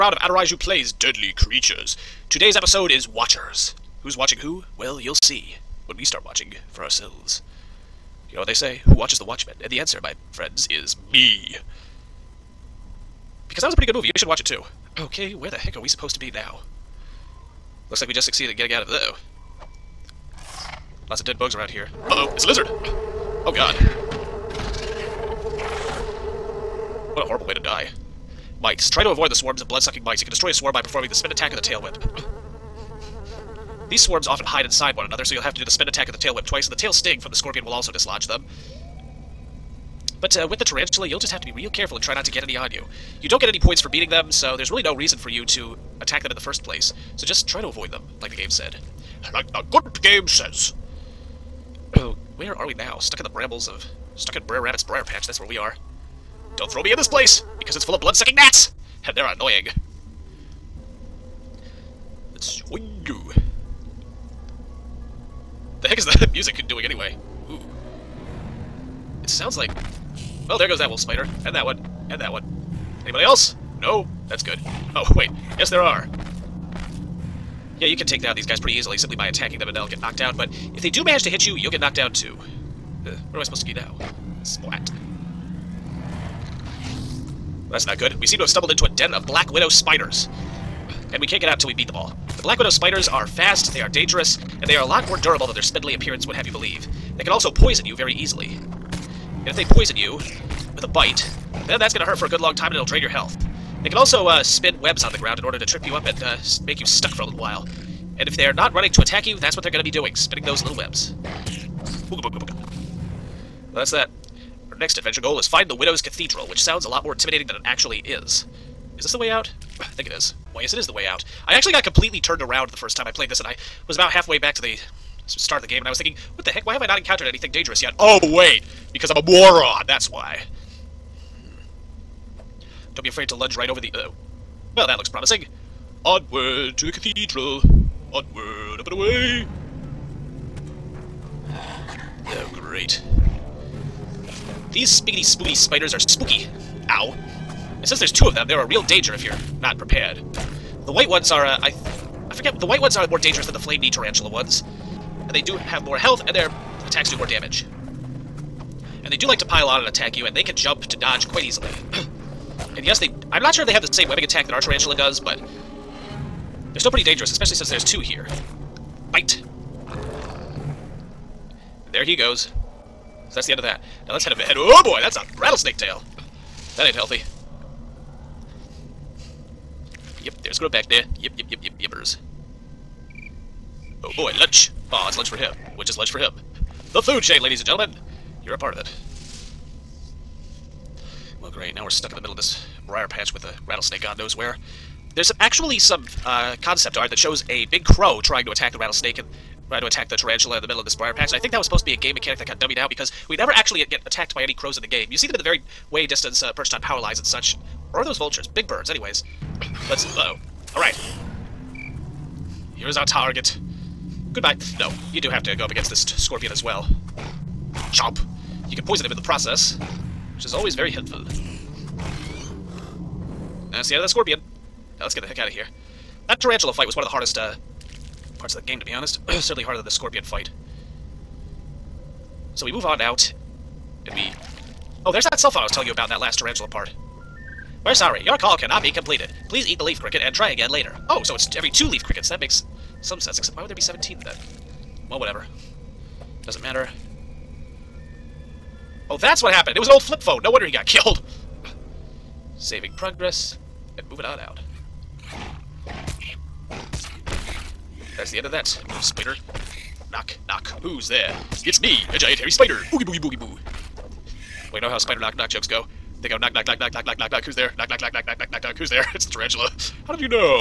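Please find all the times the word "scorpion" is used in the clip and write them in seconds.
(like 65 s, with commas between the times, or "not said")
37 s, 216 s, 224 s, 229 s.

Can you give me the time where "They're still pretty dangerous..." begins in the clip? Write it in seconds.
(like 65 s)
166 s.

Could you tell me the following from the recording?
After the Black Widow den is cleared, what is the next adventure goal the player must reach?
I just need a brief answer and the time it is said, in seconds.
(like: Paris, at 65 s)
Widow's Cathedral, at 115 s.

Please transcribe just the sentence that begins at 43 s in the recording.
You don't get any points for beating them, so there's really no reason for you to attack them in the first place.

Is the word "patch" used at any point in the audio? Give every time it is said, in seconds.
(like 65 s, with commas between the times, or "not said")
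55 s, 193 s, 201 s.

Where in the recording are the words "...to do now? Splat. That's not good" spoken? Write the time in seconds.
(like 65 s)
83 s.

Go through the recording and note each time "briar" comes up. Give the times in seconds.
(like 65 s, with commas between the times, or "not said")
54 s, 192 s, 200 s.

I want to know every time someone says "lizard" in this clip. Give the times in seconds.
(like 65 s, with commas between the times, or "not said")
22 s.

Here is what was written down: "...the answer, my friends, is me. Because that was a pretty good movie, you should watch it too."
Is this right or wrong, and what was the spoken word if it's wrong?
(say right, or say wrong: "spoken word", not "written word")
right.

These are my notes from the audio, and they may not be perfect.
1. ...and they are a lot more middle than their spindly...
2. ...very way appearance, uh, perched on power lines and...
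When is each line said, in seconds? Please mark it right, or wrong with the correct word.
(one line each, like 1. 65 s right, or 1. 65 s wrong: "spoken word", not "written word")
1. 94 s wrong: "durable", not "middle"
2. 205 s wrong: "distance", not "appearance".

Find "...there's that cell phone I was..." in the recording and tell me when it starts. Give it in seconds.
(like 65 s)
235 s.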